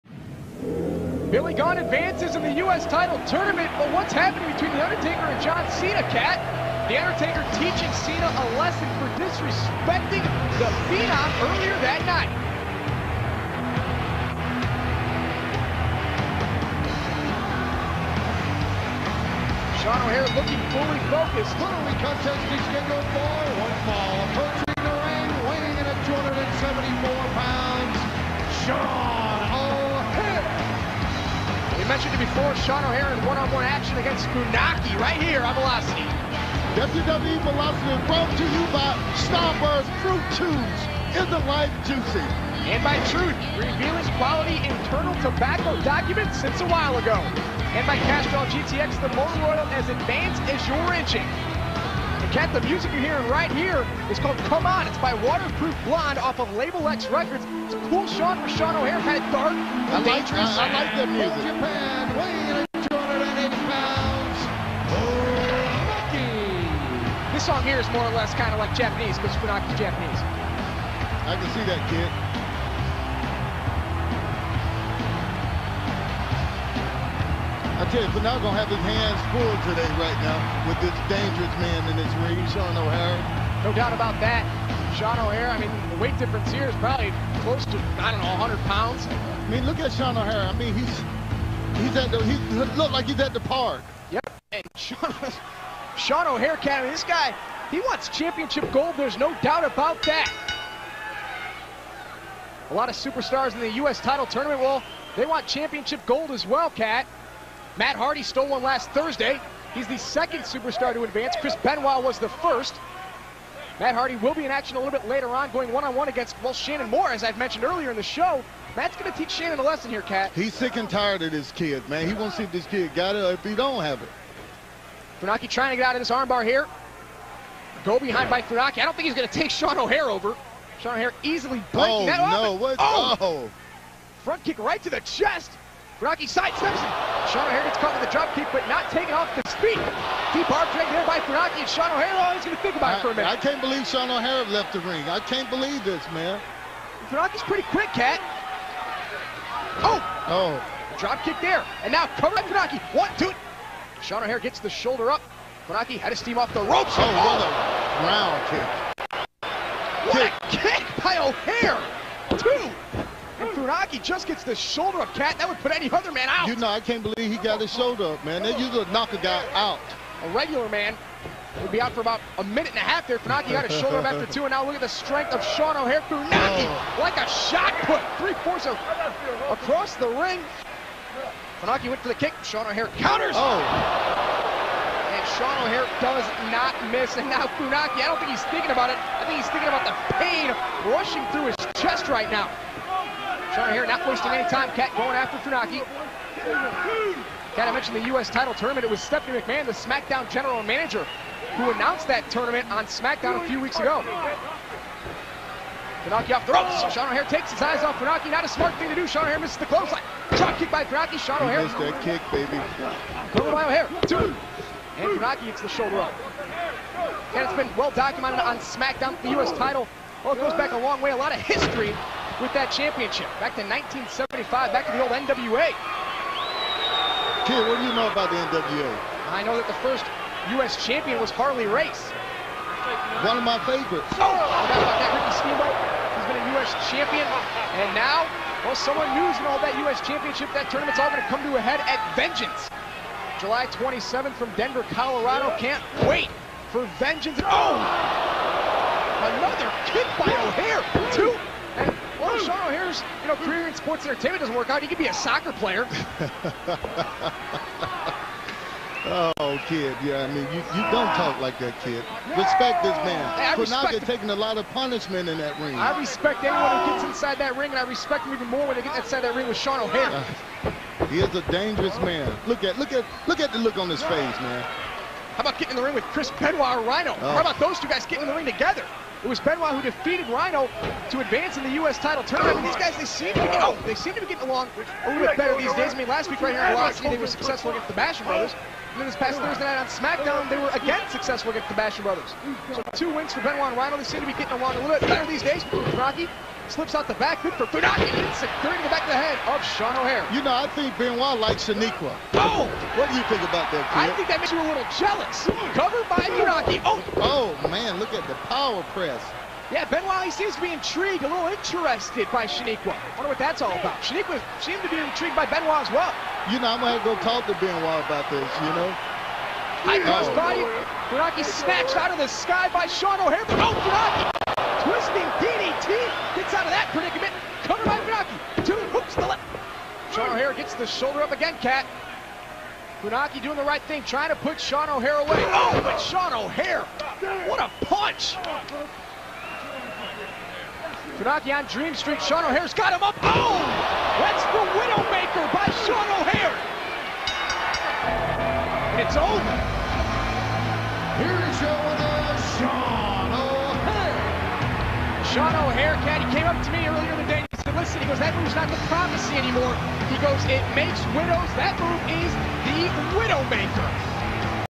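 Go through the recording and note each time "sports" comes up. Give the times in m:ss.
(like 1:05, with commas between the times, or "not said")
4:13.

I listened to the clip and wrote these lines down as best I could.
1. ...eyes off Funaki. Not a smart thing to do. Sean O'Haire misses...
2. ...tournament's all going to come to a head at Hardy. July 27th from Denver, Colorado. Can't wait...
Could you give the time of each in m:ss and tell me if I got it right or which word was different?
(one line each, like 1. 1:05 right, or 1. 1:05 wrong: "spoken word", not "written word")
1. 3:27 right
2. 4:00 wrong: "Vengeance", not "Hardy".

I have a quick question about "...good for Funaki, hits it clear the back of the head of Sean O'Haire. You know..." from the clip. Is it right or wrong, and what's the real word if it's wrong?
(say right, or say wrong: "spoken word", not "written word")
right.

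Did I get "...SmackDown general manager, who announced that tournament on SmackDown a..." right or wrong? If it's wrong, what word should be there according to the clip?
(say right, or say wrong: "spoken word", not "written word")
right.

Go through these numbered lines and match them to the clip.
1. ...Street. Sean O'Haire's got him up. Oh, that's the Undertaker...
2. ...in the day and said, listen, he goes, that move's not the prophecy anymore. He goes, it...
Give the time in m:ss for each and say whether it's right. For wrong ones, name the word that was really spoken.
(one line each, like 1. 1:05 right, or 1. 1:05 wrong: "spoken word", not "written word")
1. 5:41 wrong: "Widowmaker", not "Undertaker"
2. 5:57 right.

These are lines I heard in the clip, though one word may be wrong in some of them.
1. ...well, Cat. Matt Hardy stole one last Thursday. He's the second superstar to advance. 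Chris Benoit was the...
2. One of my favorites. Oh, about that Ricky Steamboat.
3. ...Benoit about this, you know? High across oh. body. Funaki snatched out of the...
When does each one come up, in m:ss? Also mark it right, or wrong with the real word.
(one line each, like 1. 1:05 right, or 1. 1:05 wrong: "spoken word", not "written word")
1. 1:46 right
2. 3:53 right
3. 5:17 wrong: "cross", not "across".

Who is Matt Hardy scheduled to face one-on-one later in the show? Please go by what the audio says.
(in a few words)
Shannon Moore.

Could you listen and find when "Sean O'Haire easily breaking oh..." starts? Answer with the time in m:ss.
2:10.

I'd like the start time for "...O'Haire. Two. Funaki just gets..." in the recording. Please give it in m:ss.
2:41.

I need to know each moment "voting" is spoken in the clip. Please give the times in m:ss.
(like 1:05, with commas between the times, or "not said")
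not said.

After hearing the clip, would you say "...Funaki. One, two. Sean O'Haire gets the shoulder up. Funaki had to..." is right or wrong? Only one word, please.
right.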